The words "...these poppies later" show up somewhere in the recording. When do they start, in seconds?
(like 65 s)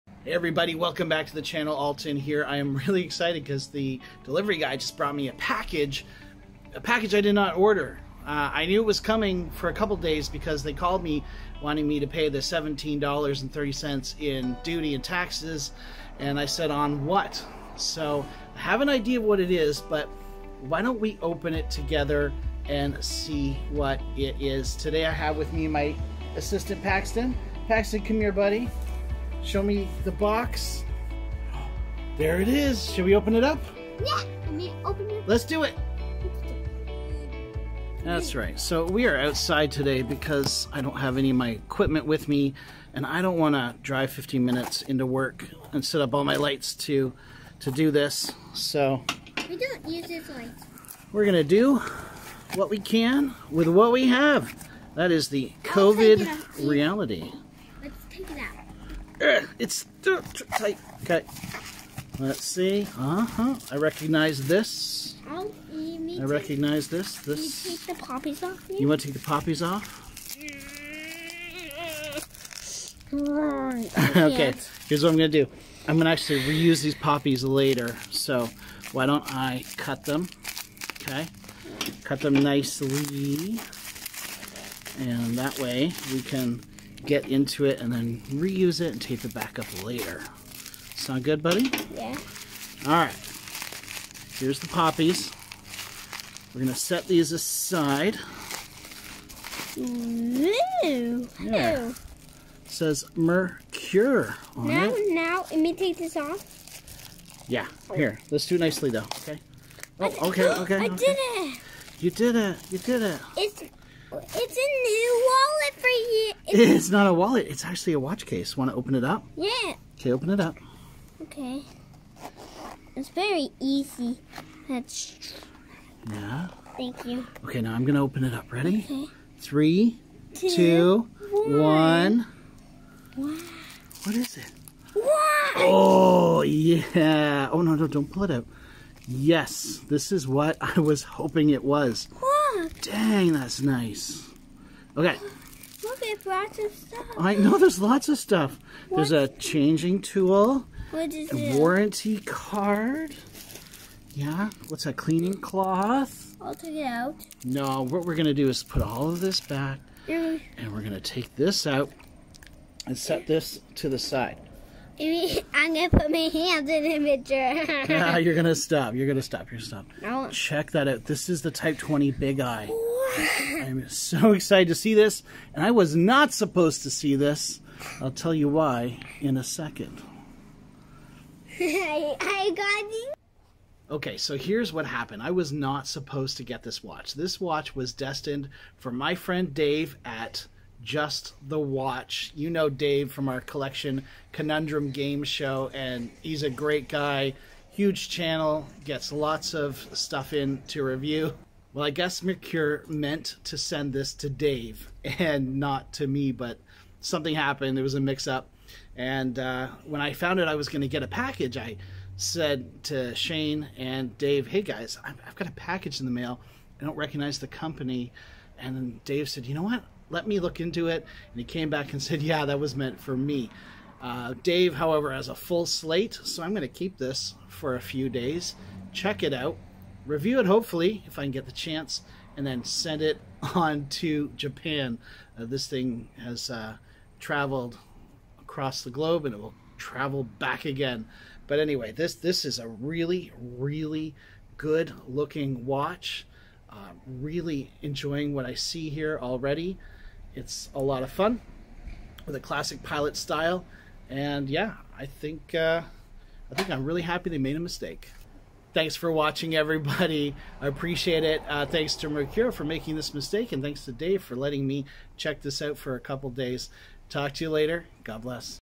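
76 s.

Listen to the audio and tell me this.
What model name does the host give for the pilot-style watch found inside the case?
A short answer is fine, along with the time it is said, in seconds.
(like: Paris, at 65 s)
Type 20 Big Eye, at 171 s.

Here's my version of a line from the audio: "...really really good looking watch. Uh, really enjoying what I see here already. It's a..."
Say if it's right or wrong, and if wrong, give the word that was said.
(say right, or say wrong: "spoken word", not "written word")
right.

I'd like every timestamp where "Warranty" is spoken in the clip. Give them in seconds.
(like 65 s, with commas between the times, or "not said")
151 s.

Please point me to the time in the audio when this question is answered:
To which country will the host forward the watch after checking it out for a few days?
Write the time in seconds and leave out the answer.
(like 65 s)
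234 s.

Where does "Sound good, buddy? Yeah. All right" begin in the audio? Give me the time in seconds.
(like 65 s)
90 s.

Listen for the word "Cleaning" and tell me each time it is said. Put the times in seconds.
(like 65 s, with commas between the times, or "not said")
154 s.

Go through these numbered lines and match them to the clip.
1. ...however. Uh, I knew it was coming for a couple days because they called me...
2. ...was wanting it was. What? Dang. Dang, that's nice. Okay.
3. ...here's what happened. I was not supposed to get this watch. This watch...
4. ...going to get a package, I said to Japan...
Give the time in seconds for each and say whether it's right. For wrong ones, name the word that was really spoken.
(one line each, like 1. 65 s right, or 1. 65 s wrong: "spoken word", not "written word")
1. 7 s wrong: "order", not "however"
2. 140 s wrong: "hoping", not "wanting"
3. 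184 s right
4. 210 s wrong: "Shane", not "Japan".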